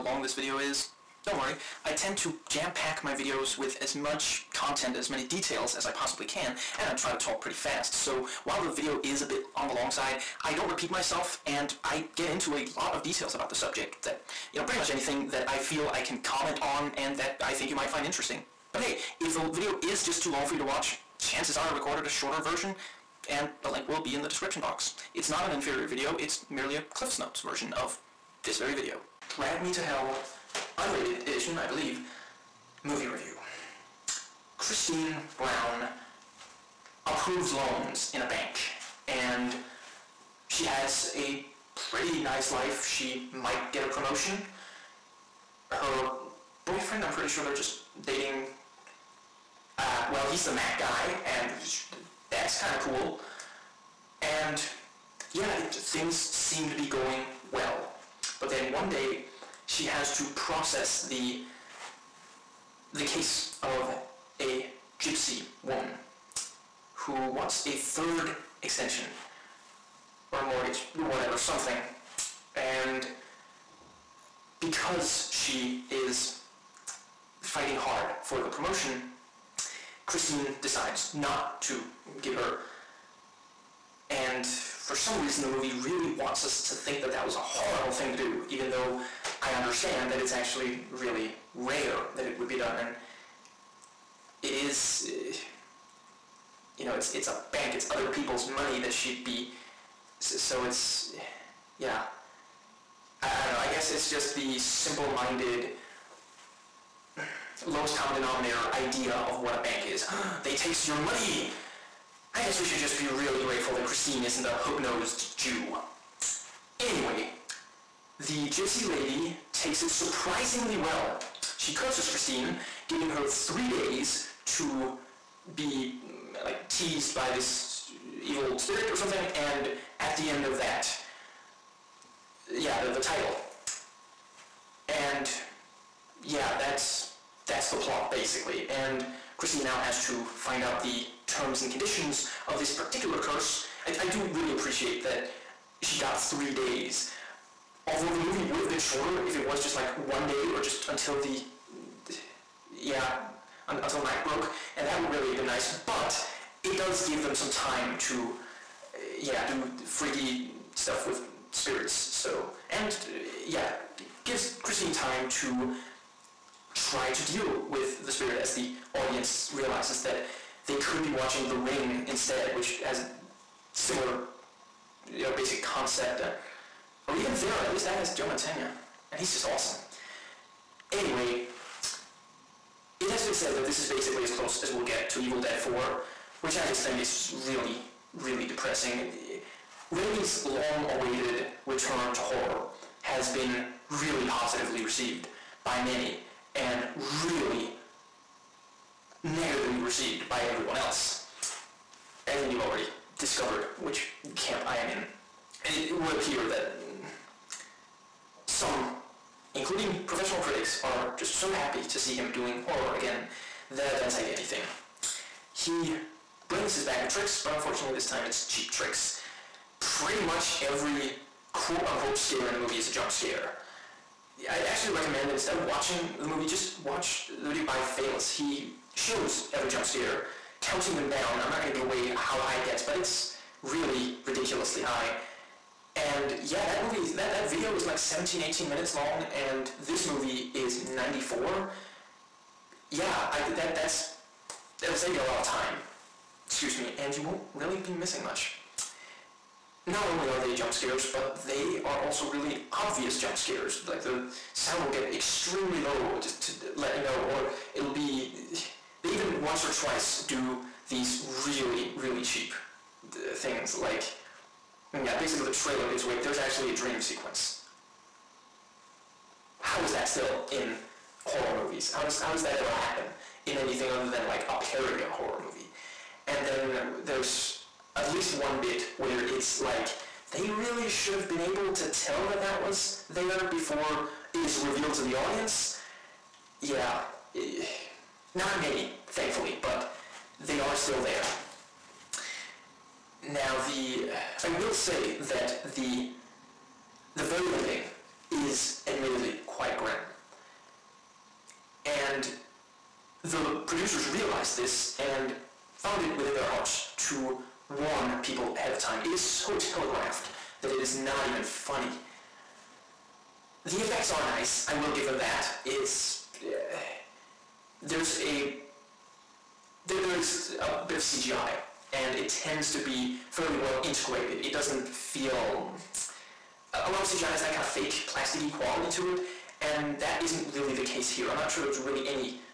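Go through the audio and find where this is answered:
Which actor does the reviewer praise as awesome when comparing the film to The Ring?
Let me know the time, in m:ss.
2:58.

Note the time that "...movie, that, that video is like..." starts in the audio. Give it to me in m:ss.
3:56.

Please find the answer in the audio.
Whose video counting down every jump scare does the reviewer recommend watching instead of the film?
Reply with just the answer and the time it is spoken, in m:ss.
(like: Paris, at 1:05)
Phalas, at 3:47.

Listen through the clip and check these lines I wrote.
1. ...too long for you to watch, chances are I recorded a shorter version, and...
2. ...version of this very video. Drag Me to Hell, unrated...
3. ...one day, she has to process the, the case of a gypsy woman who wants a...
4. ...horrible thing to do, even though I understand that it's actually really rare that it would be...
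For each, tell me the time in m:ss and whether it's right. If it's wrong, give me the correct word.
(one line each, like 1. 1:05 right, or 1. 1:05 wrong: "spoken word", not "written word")
1. 0:20 right
2. 0:27 right
3. 0:58 right
4. 1:27 right.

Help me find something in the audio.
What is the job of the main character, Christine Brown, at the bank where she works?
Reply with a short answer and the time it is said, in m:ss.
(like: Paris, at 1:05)
Approves loans, at 0:37.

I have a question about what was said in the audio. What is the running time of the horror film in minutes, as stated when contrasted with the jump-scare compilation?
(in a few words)
94.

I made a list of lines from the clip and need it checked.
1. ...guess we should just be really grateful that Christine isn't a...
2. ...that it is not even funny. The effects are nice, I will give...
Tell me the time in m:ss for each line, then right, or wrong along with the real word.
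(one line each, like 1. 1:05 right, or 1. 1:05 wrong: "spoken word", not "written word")
1. 1:52 right
2. 5:10 right.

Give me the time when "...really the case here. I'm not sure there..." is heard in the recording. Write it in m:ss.
5:30.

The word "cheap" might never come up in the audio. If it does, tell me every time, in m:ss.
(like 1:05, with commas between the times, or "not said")
3:38, 4:22.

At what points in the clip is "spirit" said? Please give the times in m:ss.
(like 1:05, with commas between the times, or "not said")
2:08, 2:41, 2:48.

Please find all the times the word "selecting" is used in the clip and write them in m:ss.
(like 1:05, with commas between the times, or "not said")
not said.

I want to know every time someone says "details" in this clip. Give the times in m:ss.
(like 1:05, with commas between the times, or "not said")
0:05, 0:13.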